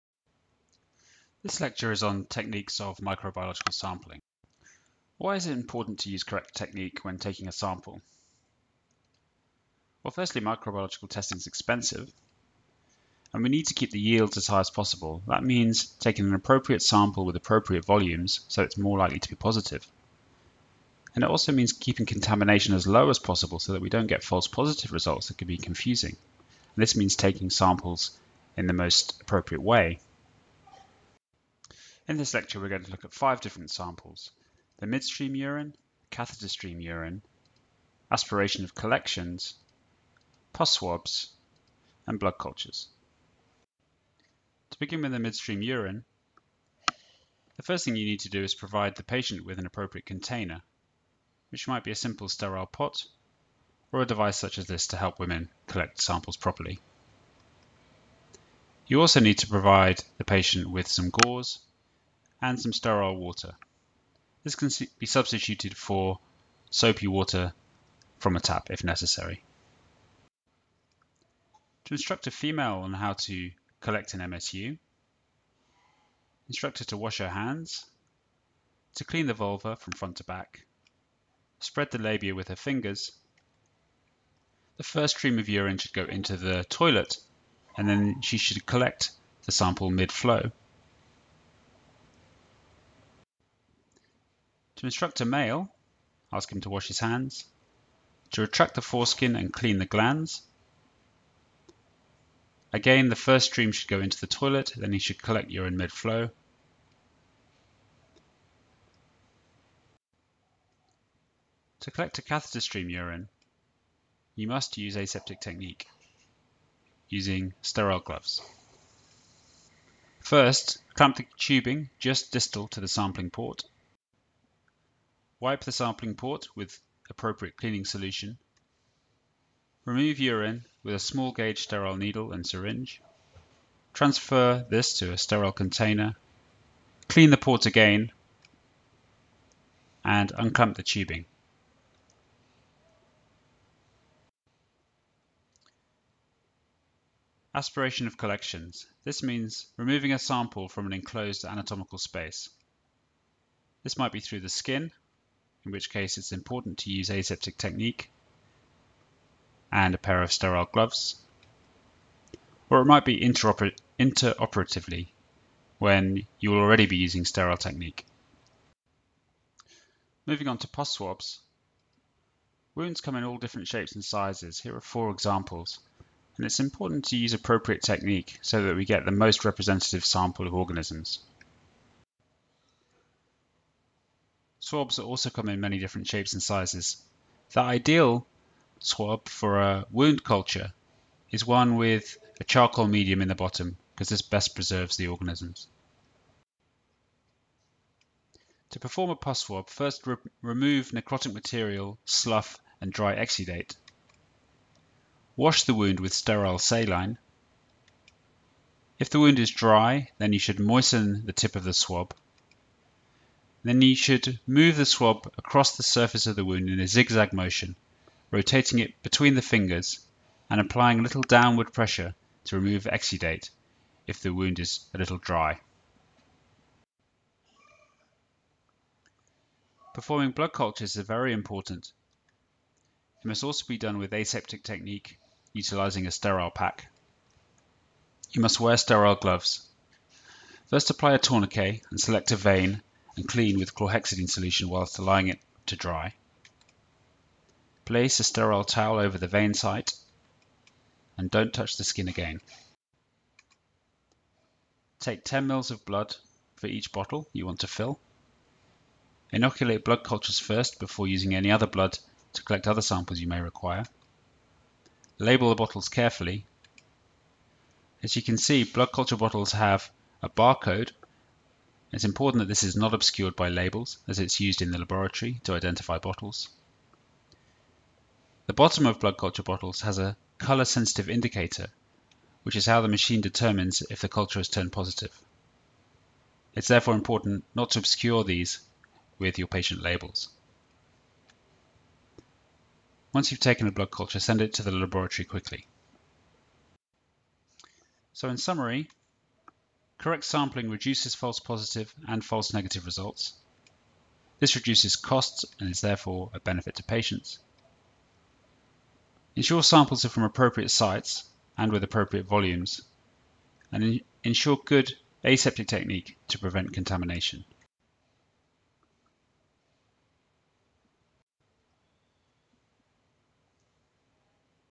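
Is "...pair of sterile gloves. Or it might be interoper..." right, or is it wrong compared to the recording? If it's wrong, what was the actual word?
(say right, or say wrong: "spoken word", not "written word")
right.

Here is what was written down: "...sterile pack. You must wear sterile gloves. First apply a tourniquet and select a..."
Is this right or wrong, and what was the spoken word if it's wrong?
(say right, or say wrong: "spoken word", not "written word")
right.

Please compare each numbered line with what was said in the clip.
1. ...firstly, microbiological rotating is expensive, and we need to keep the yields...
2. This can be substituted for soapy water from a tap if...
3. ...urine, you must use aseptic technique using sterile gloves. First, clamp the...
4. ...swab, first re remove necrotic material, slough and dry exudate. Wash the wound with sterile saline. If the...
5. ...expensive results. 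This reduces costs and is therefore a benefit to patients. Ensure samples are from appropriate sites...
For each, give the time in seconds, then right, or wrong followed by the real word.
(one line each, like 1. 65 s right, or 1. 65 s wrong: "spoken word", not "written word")
1. 10 s wrong: "testing", not "rotating"
2. 64 s right
3. 112 s right
4. 199 s right
5. 302 s wrong: "negative", not "expensive".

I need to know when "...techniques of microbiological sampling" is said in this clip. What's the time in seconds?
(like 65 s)
2 s.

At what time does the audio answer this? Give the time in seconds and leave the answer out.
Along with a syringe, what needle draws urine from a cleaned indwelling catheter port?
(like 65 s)
130 s.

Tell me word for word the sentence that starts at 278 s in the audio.
The bottom of blood culture bottles has a colour-sensitive indicator, which is how the machine determines if the culture has turned positive.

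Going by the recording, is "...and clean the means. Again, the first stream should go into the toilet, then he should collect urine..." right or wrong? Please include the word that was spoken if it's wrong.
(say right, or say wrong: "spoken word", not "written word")
wrong: "glans", not "means".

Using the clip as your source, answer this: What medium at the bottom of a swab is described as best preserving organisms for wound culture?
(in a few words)
charcoal.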